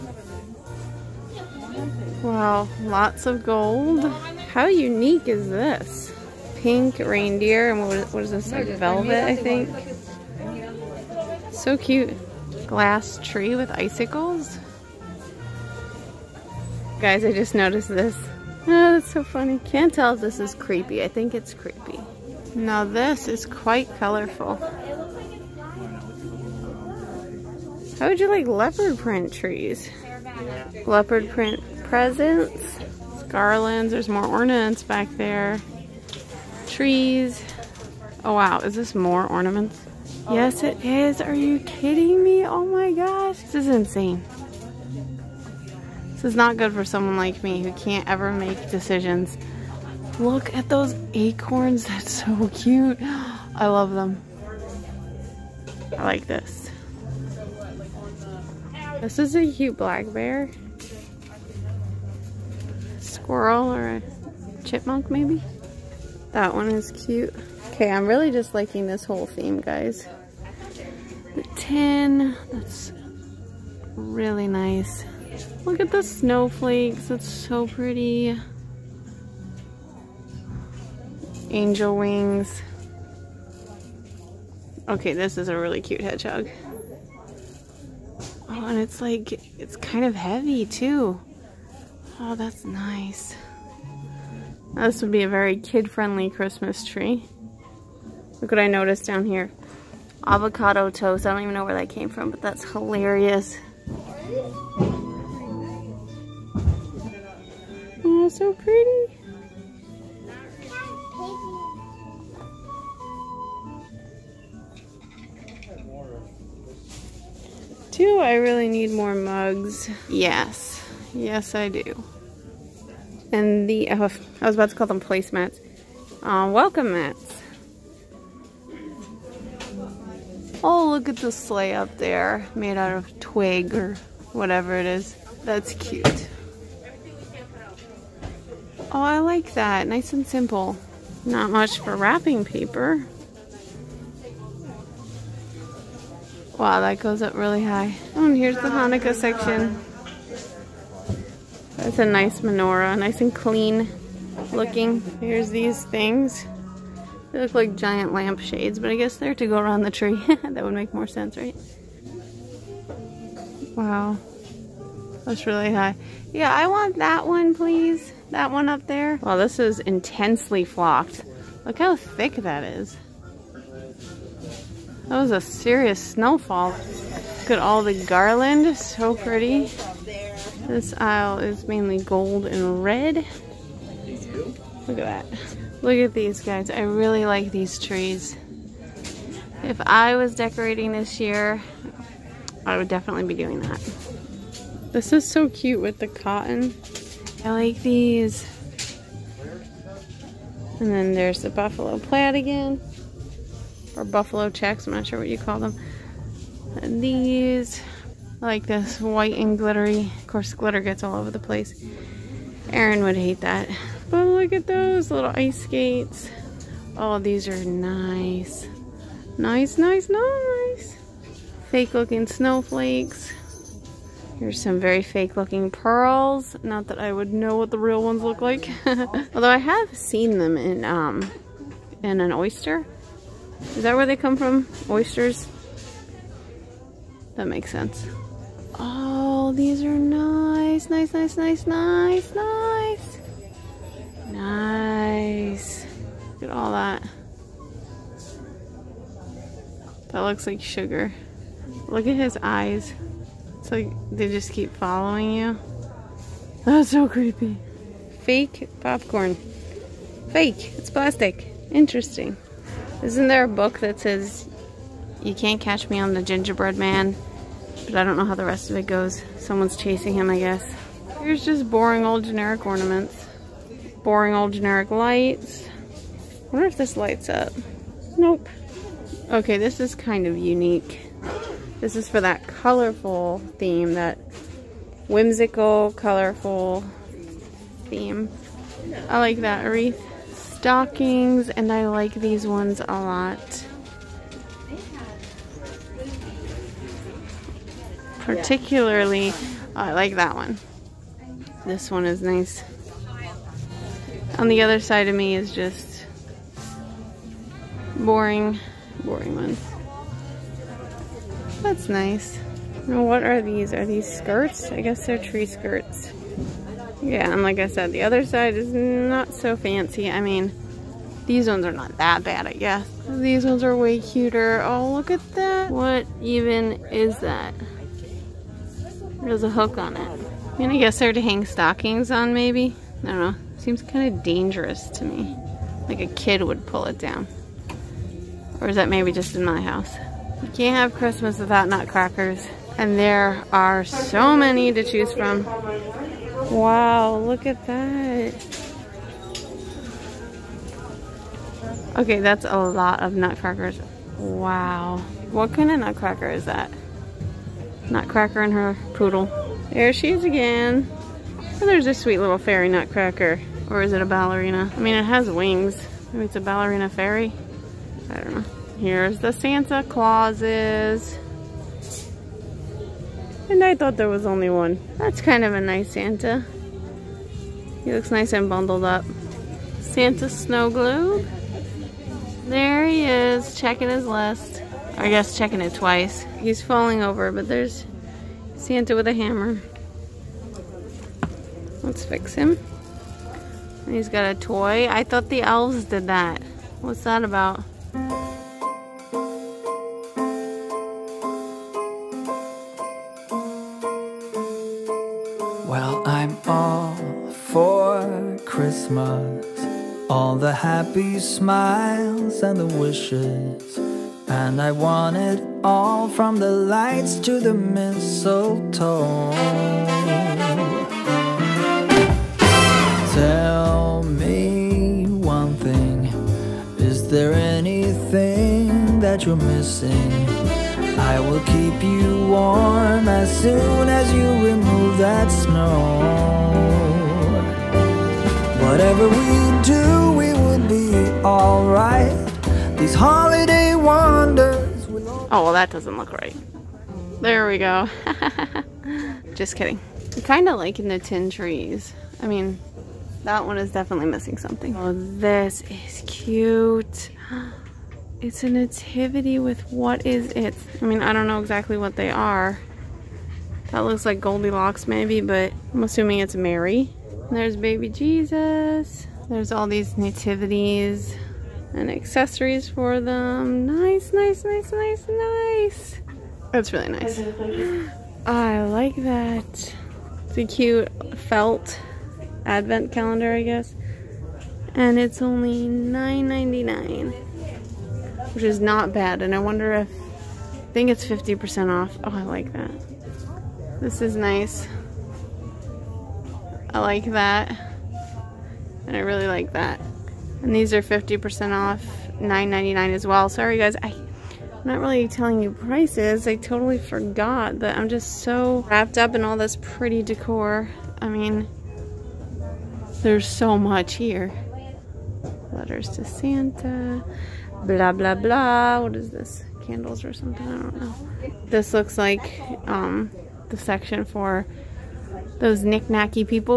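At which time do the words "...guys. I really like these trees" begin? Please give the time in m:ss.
3:06.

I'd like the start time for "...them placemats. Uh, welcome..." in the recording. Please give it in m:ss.
2:04.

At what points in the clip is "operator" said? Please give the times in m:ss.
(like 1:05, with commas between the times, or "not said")
not said.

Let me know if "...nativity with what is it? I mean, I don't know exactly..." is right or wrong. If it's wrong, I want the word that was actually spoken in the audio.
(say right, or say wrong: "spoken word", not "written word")
right.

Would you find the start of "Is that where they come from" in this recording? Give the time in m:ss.
3:53.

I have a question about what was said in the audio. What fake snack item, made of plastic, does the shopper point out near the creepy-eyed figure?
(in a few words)
Popcorn.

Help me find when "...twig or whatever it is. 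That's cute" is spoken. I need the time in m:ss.
2:13.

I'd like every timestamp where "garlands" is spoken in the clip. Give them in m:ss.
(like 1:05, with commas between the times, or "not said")
0:33, 2:58.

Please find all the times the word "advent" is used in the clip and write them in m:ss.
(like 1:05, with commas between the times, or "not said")
8:02.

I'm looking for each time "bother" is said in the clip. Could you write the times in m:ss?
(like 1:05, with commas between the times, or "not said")
not said.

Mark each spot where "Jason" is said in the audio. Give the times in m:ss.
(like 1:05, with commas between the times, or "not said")
not said.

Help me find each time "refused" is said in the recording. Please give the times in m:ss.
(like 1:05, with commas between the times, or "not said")
not said.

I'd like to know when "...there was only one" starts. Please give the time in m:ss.
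6:13.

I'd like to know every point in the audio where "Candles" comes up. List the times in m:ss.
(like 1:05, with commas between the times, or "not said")
8:39.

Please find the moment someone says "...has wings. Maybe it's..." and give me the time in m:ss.
6:05.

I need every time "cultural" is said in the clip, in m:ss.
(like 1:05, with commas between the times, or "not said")
not said.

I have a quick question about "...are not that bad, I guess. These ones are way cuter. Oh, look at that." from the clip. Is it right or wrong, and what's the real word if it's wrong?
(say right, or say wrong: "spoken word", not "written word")
right.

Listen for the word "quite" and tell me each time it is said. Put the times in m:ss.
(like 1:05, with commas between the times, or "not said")
0:23.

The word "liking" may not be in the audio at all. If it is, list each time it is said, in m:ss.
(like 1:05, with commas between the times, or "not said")
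1:08, 7:30.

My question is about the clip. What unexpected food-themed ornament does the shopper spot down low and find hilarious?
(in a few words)
Avocado toast.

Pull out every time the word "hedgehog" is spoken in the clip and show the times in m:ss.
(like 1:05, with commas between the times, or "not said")
1:26.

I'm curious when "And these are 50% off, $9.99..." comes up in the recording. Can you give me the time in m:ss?
8:20.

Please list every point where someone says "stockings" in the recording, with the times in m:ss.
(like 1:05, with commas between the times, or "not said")
4:50, 5:31.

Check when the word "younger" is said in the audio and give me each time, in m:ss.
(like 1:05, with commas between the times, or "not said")
not said.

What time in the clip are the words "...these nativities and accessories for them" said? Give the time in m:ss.
7:49.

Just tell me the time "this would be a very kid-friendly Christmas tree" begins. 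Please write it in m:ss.
1:34.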